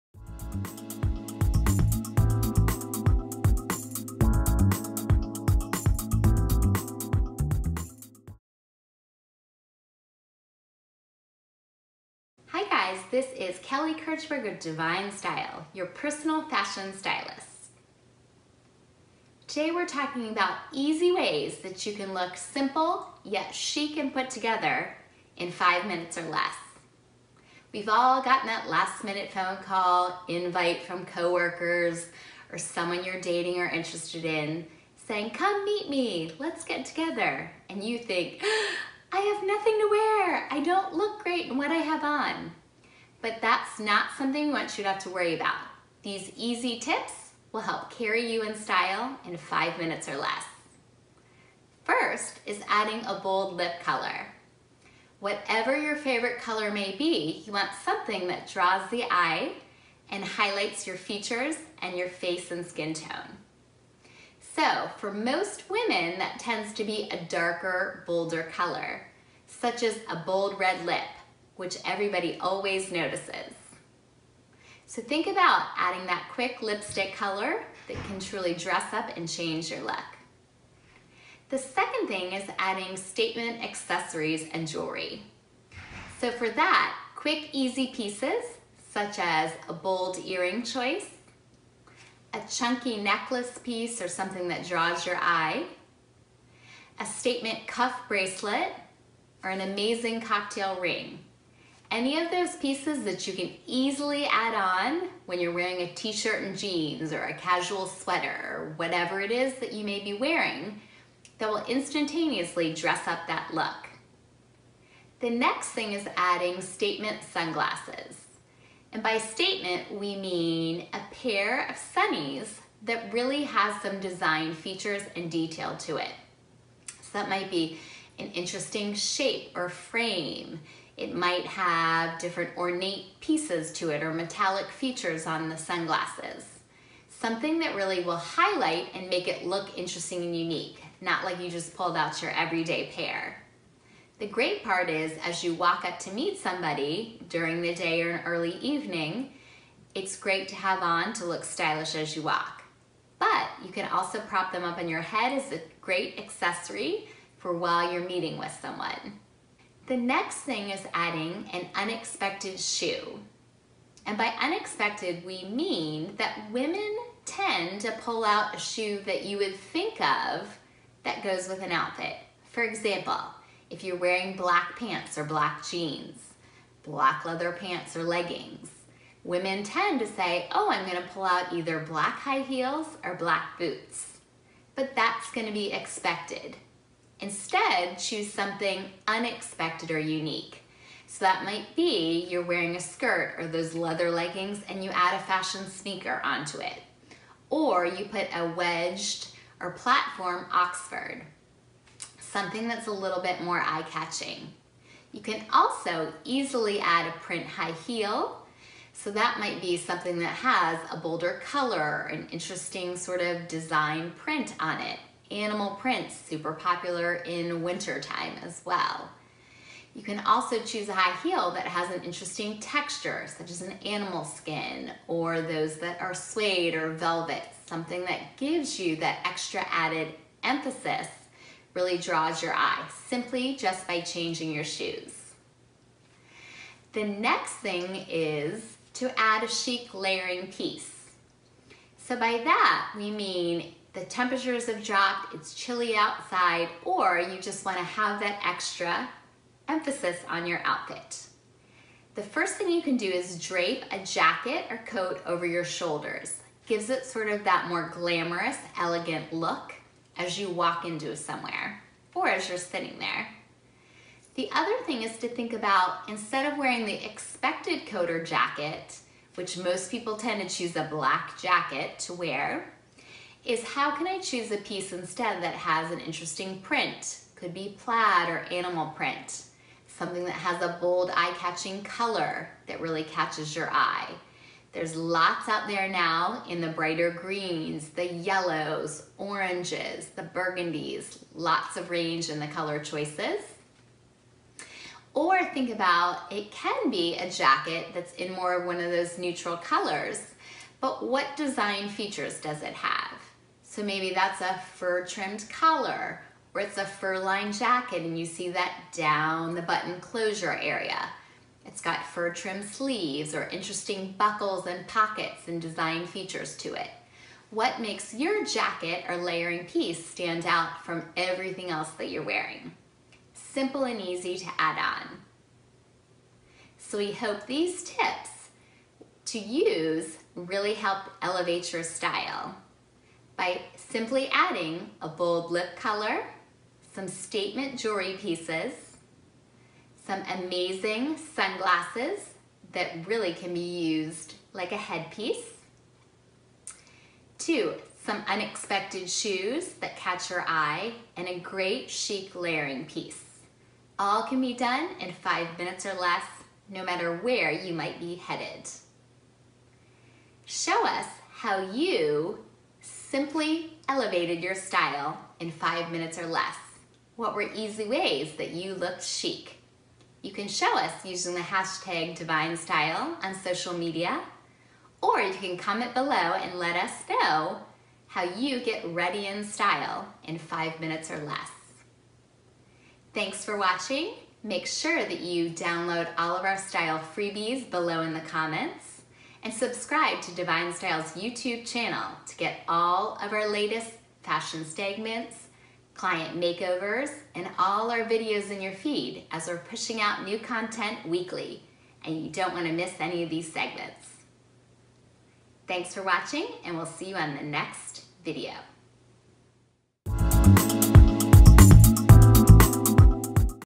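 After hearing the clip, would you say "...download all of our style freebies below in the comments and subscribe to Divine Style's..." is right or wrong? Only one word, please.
right.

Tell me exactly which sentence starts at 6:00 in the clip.
Show us how you simply elevated your style in five minutes or less.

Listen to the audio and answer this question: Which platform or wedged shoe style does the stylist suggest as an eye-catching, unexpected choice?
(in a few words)
Oxford.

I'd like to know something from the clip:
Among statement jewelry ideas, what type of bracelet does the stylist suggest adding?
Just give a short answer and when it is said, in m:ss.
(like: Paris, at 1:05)
statement cuff bracelet, at 1:37.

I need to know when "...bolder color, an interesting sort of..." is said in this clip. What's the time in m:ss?
3:30.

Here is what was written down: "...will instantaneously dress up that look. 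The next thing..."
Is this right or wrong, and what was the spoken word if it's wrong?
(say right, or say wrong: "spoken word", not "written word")
right.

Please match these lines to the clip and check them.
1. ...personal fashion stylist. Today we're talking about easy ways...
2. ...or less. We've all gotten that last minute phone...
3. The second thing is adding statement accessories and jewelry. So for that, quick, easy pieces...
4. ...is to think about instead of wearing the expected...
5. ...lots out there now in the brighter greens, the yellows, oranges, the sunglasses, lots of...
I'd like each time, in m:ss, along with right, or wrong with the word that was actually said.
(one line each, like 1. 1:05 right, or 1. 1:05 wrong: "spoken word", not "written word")
1. 0:15 right
2. 0:26 right
3. 1:21 right
4. 4:25 right
5. 4:44 wrong: "burgundies", not "sunglasses".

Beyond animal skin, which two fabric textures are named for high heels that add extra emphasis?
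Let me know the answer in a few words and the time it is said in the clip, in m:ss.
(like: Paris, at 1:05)
suede or velvet, at 3:46.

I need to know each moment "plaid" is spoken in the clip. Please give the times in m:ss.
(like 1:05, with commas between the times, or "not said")
4:37.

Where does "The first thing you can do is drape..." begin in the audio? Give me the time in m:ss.
4:12.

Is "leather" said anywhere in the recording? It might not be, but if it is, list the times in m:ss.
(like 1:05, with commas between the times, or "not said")
2:57, 3:13.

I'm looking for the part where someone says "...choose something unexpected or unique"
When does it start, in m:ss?
3:07.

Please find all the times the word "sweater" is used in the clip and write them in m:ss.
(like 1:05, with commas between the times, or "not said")
1:47.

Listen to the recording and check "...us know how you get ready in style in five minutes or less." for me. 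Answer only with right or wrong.
right.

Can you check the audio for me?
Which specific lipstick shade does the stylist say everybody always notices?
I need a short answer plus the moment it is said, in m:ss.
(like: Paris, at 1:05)
bold red, at 1:10.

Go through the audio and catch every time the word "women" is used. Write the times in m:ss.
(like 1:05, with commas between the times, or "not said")
1:05, 2:46, 2:59.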